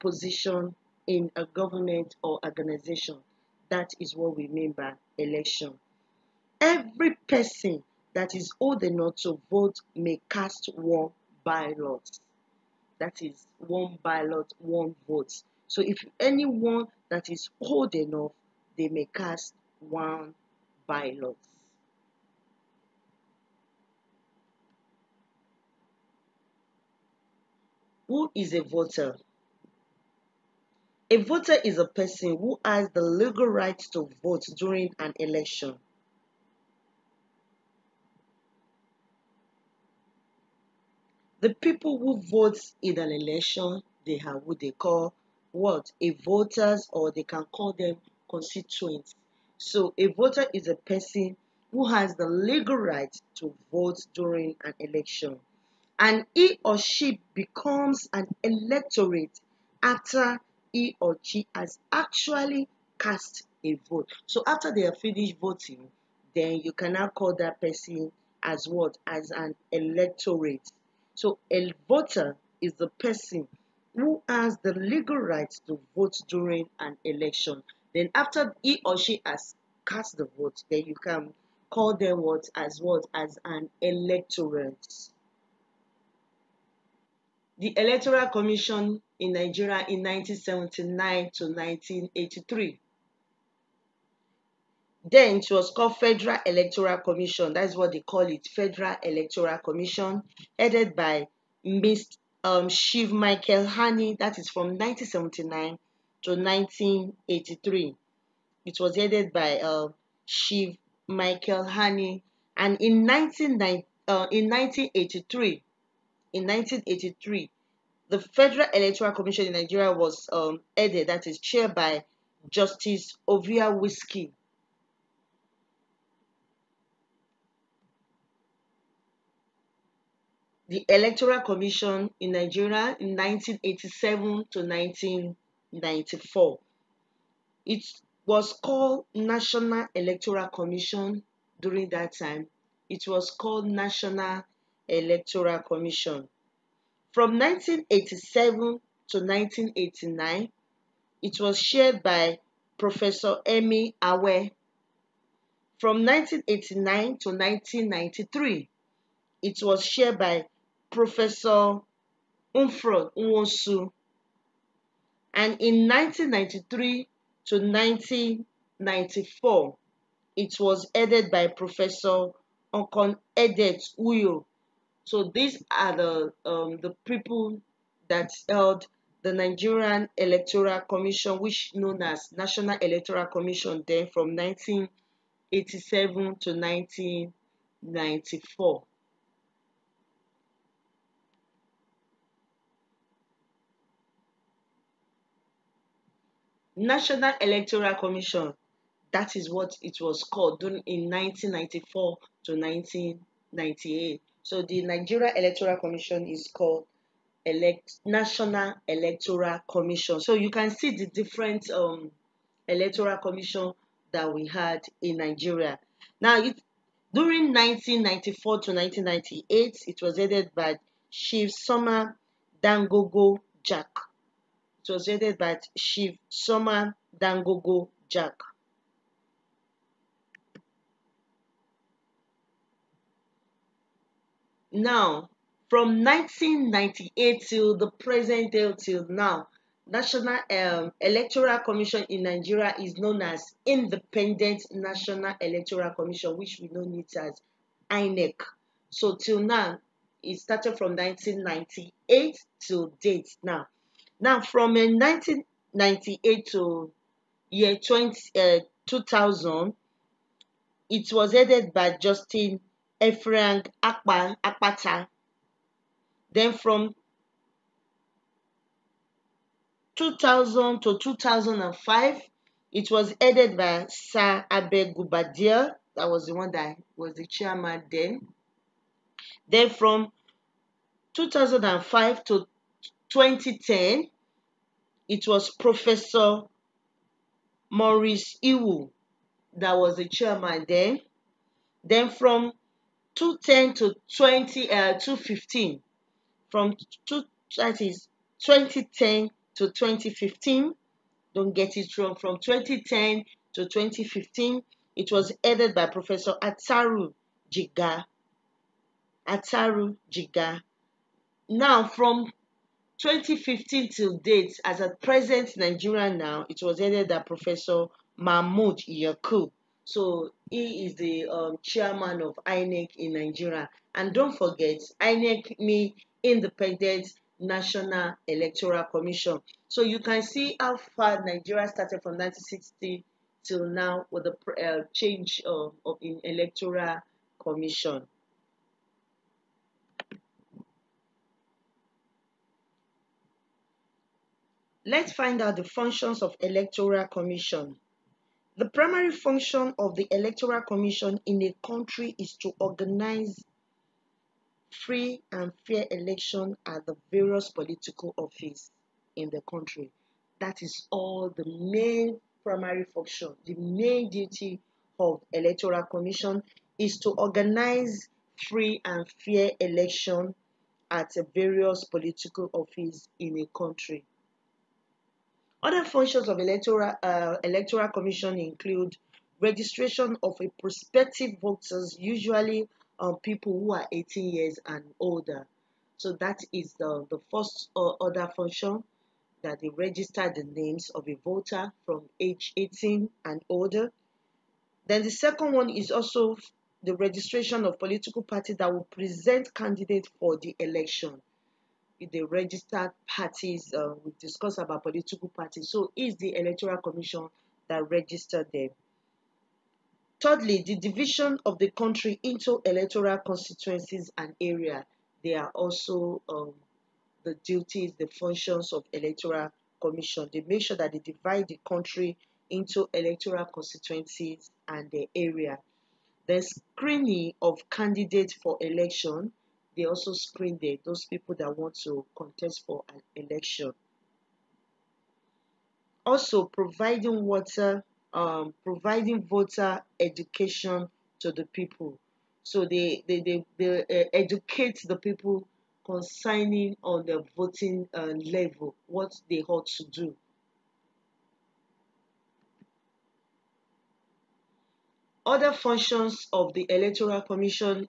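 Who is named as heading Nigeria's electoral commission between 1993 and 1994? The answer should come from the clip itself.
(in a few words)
Professor Okon Edet Uya.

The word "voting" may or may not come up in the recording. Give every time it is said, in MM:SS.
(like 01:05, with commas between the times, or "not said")
01:05, 07:27.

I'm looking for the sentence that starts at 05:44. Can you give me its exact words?
Let's find out the functions of Electoral Commission.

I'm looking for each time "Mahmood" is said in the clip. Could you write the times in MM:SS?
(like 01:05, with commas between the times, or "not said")
05:18.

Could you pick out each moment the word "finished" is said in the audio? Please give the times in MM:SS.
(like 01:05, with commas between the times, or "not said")
01:04.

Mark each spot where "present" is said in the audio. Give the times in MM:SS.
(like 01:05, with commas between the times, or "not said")
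03:57, 05:15, 06:38.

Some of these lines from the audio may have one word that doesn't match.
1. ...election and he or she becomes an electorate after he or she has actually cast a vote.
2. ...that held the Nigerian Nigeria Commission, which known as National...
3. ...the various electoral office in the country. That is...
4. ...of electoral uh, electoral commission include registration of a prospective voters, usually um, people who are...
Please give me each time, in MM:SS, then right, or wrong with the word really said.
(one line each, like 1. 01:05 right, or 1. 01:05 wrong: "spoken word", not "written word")
1. 00:54 right
2. 02:58 wrong: "Electoral", not "Nigeria"
3. 05:56 wrong: "political", not "electoral"
4. 06:16 right.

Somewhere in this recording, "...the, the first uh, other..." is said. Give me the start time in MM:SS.
06:26.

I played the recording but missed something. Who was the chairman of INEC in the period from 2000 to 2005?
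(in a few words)
Sir Abe Guobadia.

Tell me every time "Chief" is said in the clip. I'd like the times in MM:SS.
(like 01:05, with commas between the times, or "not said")
01:42, 01:50, 03:41, 03:45.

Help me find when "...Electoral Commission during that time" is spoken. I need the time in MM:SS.
02:19.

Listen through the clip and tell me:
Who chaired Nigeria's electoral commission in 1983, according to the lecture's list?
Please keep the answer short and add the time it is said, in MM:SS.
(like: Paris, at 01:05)
Justice Ovie-Whiskey, at 02:02.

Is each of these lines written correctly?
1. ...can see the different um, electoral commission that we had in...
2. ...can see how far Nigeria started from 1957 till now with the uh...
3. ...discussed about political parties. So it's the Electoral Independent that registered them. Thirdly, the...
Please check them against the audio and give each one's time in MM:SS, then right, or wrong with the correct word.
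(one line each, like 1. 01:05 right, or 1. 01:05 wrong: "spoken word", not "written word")
1. 03:30 right
2. 05:29 wrong: "1960", not "1957"
3. 06:44 wrong: "Commission", not "Independent".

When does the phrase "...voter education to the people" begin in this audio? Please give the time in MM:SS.
07:19.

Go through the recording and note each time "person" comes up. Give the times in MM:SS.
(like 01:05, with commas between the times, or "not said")
00:07, 00:31, 00:50, 01:07, 01:12.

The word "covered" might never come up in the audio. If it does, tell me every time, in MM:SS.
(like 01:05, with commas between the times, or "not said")
not said.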